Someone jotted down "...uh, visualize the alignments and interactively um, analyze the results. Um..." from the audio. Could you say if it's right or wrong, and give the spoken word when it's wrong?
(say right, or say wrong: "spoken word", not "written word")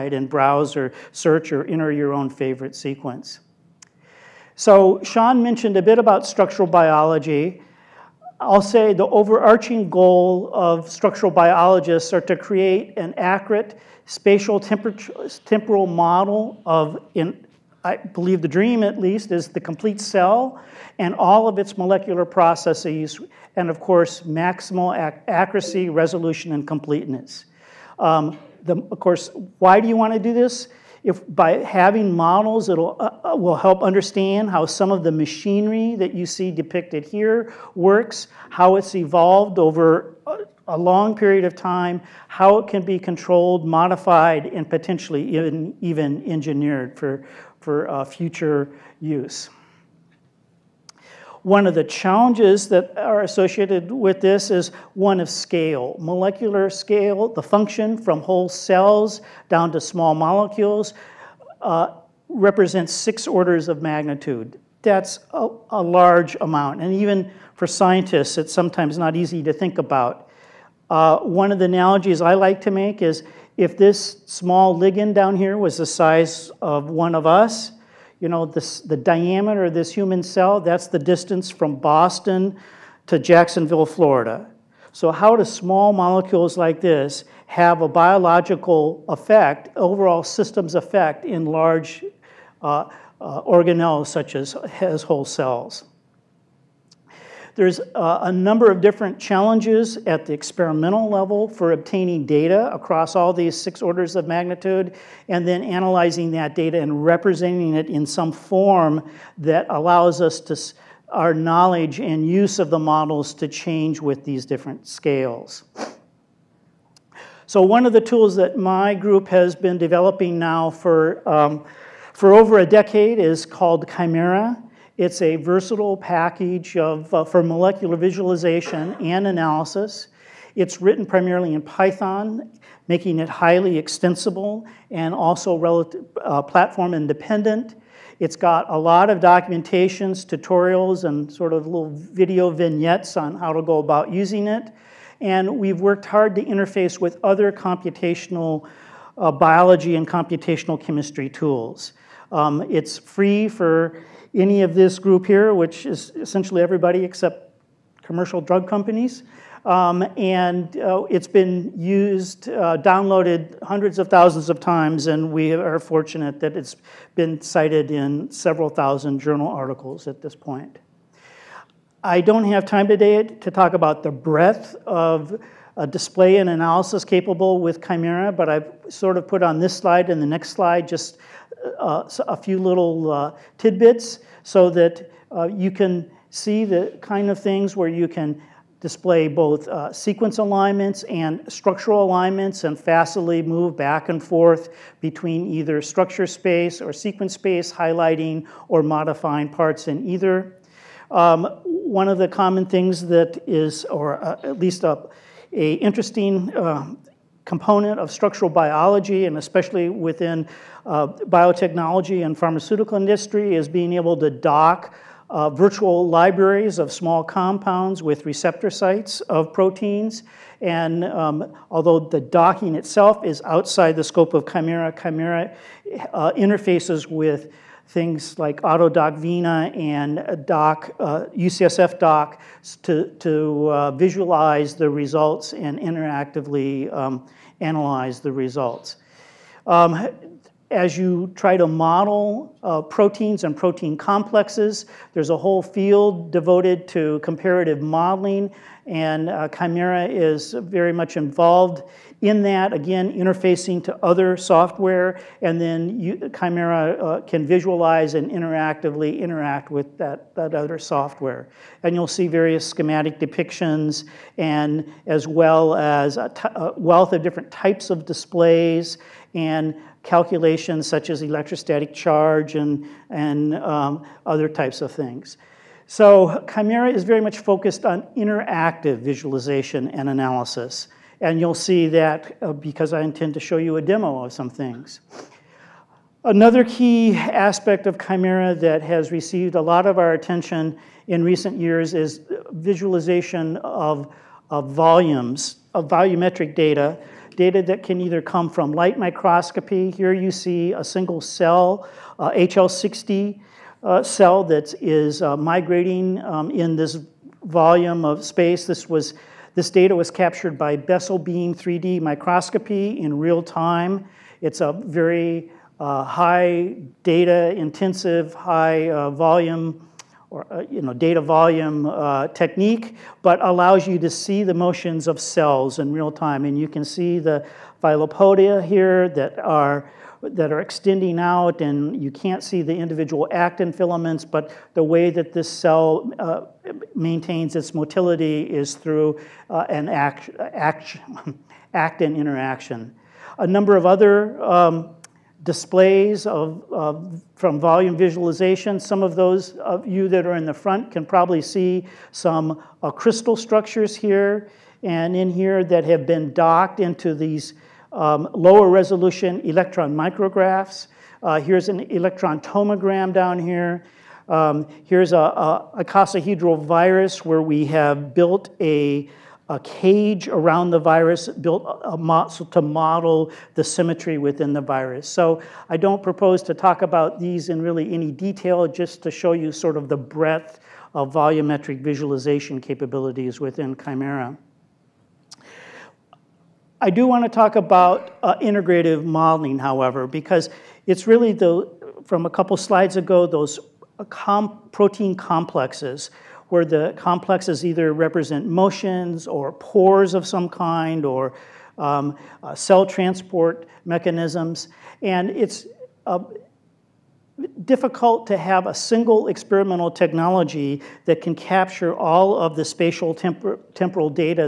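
wrong: "results", not "alignments".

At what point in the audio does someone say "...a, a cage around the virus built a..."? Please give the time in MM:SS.
06:08.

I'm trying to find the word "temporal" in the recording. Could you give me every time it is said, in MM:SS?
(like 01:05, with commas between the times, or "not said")
00:14, 06:53.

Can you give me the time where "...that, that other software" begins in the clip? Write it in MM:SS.
04:19.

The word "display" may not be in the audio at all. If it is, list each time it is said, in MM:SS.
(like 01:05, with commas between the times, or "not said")
02:55, 03:08, 04:28, 05:45.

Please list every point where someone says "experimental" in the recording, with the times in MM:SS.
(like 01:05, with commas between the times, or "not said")
01:40, 06:49.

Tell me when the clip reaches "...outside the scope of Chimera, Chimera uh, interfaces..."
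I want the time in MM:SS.
03:43.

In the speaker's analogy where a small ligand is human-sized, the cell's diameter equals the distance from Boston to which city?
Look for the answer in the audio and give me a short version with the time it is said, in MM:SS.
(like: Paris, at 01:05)
Jacksonville, Florida, at 01:23.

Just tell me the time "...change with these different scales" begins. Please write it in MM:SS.
01:53.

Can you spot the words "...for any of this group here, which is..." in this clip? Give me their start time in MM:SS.
02:33.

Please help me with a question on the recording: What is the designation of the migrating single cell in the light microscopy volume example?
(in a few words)
HL60.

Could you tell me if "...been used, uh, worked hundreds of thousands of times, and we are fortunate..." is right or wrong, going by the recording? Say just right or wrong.
wrong.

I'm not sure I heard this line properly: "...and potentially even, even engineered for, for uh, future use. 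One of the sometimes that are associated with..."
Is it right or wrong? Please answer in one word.
wrong.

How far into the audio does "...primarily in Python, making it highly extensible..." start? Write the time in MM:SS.
02:11.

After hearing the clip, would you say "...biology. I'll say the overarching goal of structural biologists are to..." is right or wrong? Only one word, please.
right.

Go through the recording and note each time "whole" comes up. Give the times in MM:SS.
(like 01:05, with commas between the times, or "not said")
00:58, 01:35, 04:05.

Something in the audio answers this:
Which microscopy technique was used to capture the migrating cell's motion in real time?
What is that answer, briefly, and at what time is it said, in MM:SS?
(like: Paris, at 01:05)
Bessel beam 3D microscopy, at 05:10.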